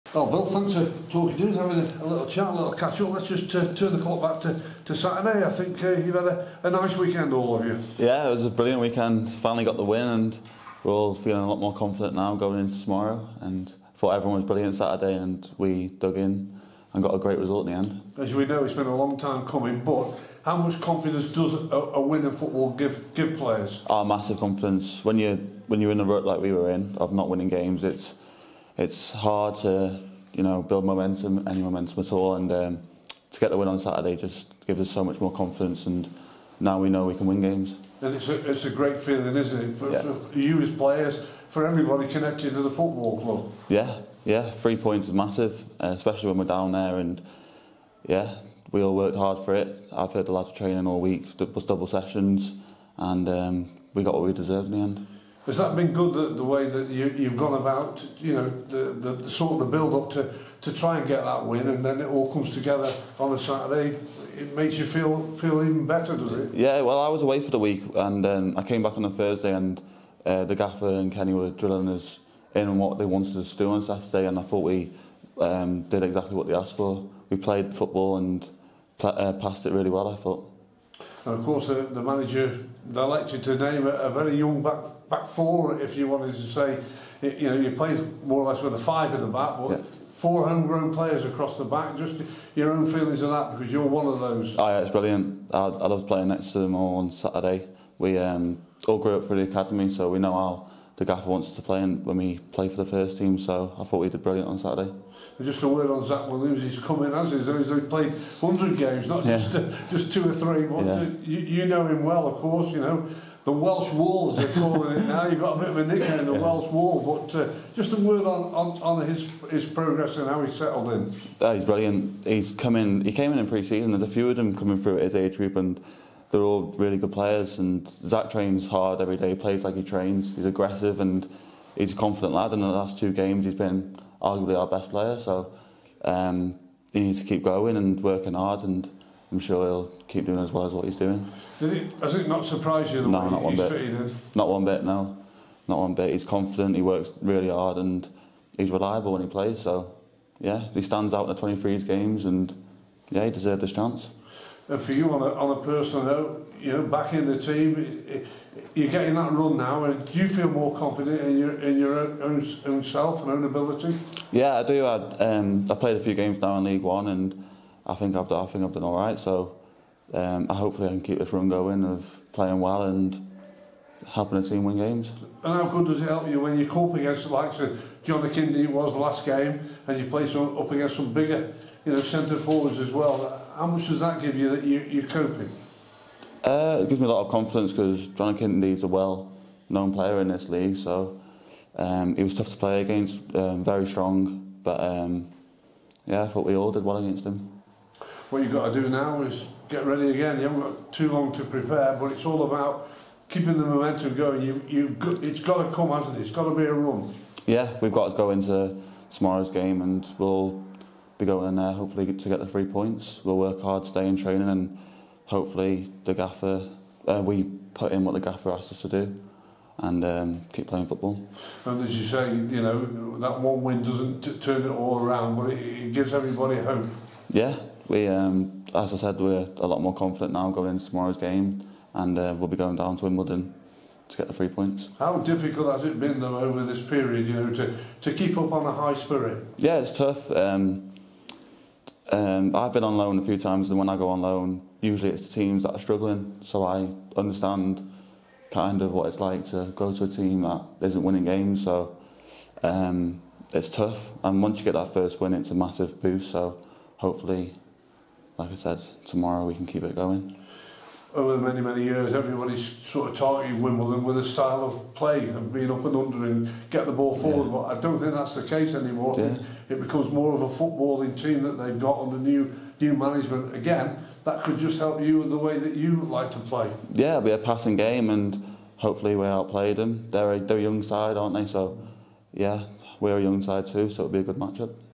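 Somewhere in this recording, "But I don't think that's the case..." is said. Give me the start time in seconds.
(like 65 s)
267 s.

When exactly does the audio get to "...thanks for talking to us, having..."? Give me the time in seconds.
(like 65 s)
0 s.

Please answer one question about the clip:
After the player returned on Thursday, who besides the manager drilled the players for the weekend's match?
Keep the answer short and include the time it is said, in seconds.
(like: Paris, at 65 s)
Kenny, at 71 s.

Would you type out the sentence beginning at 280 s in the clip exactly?
They're a, they're a young side, aren't they?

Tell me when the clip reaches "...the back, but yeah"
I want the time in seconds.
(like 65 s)
89 s.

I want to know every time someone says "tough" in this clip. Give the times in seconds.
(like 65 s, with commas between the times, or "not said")
192 s, 239 s, 253 s.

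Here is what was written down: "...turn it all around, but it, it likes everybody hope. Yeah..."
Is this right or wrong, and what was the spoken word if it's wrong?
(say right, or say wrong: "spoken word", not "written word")
wrong: "gives", not "likes".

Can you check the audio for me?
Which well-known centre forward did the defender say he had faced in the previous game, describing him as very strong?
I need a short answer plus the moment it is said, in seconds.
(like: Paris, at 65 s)
John McKinney, at 178 s.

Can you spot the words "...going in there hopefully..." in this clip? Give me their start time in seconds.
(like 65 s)
211 s.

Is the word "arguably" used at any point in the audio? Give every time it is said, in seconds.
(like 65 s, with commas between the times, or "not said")
134 s.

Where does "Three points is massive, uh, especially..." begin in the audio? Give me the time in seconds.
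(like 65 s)
44 s.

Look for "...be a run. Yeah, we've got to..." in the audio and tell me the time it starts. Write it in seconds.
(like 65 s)
206 s.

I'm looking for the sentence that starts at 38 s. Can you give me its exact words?
And it's a, it's a great feeling, isn't it, for, yeah.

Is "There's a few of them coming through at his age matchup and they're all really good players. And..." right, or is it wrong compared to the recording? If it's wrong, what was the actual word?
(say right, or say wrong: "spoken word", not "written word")
wrong: "group", not "matchup".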